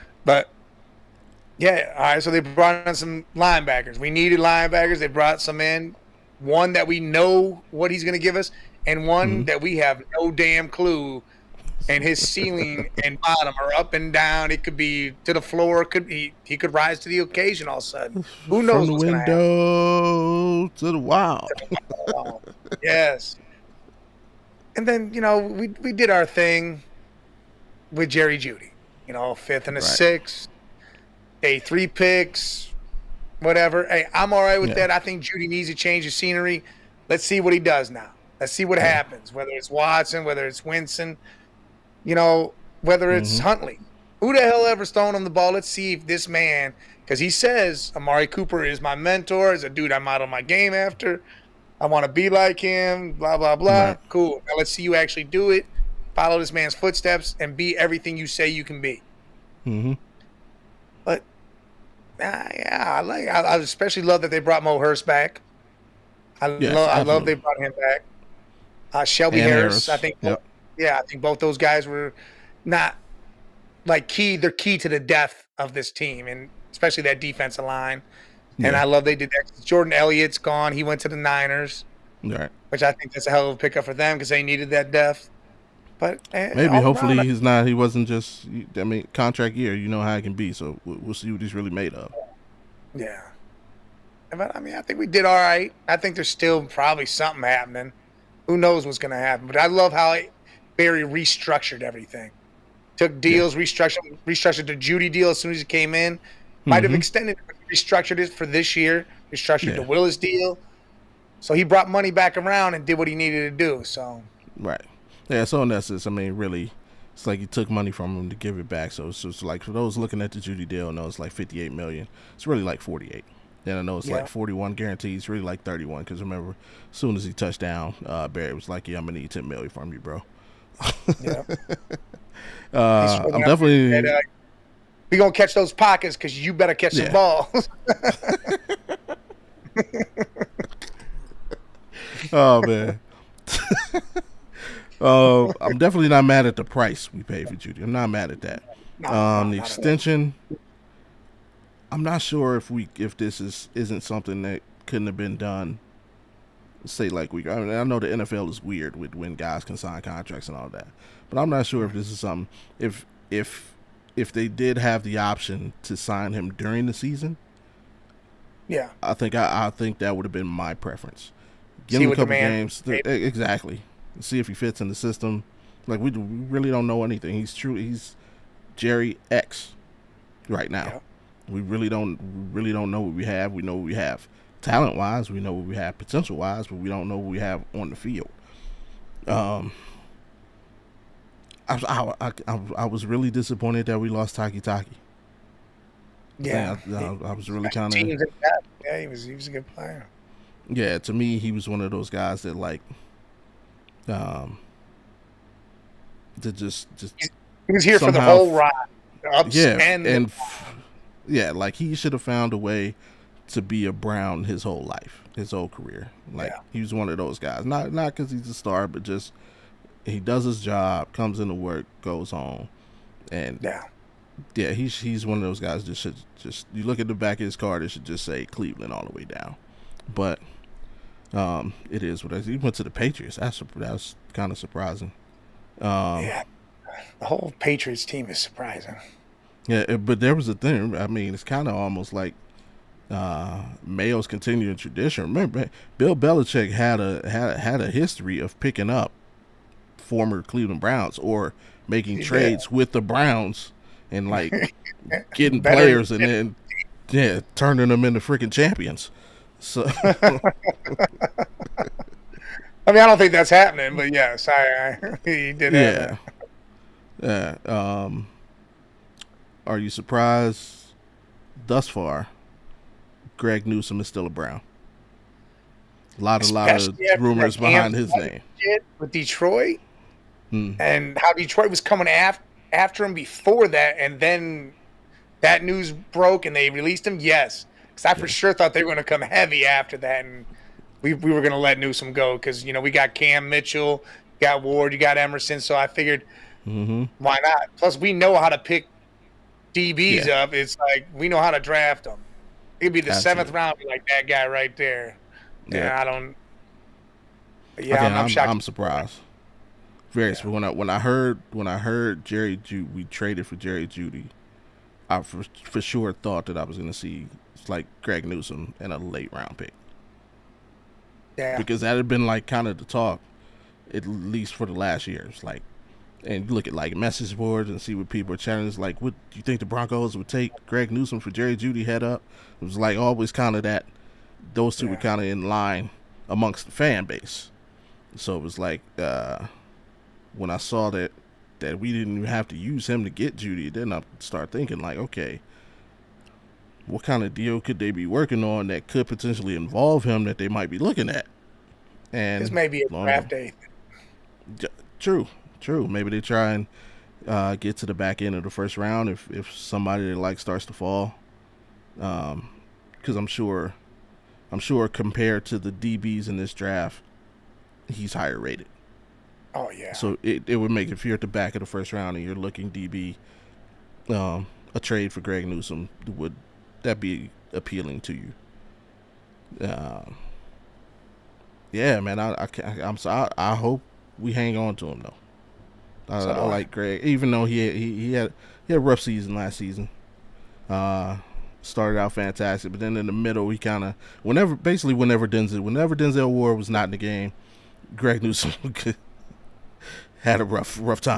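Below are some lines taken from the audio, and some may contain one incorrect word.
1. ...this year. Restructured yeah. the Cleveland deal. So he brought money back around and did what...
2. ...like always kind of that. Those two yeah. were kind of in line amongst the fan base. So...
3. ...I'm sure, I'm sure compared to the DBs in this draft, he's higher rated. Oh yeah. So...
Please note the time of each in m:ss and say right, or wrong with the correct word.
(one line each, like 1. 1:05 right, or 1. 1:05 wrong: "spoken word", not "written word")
1. 1:48 wrong: "Wills", not "Cleveland"
2. 5:32 right
3. 6:03 right.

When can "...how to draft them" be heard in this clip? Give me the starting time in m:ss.
5:01.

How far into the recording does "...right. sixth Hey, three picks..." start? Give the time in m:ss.
0:29.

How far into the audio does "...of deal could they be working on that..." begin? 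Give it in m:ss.
5:47.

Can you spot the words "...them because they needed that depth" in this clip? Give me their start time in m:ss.
1:23.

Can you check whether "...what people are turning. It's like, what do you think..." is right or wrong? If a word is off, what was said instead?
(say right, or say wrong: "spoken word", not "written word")
wrong: "chatting", not "turning".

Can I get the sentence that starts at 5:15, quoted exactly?
I for, for sure thought that I was going to see like Greg Newsome and a late round pick.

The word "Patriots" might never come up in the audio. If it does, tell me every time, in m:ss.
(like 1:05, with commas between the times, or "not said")
3:52, 3:57.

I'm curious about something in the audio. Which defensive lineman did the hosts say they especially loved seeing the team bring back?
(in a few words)
Mo Hurst.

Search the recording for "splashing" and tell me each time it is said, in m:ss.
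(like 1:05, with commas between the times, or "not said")
not said.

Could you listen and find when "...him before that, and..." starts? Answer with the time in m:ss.
4:43.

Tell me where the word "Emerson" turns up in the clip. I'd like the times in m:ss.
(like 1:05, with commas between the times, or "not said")
4:55.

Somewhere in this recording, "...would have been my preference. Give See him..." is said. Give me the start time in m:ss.
2:50.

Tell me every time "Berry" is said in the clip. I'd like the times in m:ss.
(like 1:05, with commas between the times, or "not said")
1:40, 2:08.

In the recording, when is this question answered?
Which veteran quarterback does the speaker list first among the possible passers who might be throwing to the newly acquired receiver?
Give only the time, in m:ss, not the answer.
0:39.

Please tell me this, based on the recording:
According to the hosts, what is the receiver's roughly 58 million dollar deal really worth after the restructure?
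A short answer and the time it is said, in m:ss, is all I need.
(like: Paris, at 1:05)
48 million, at 2:02.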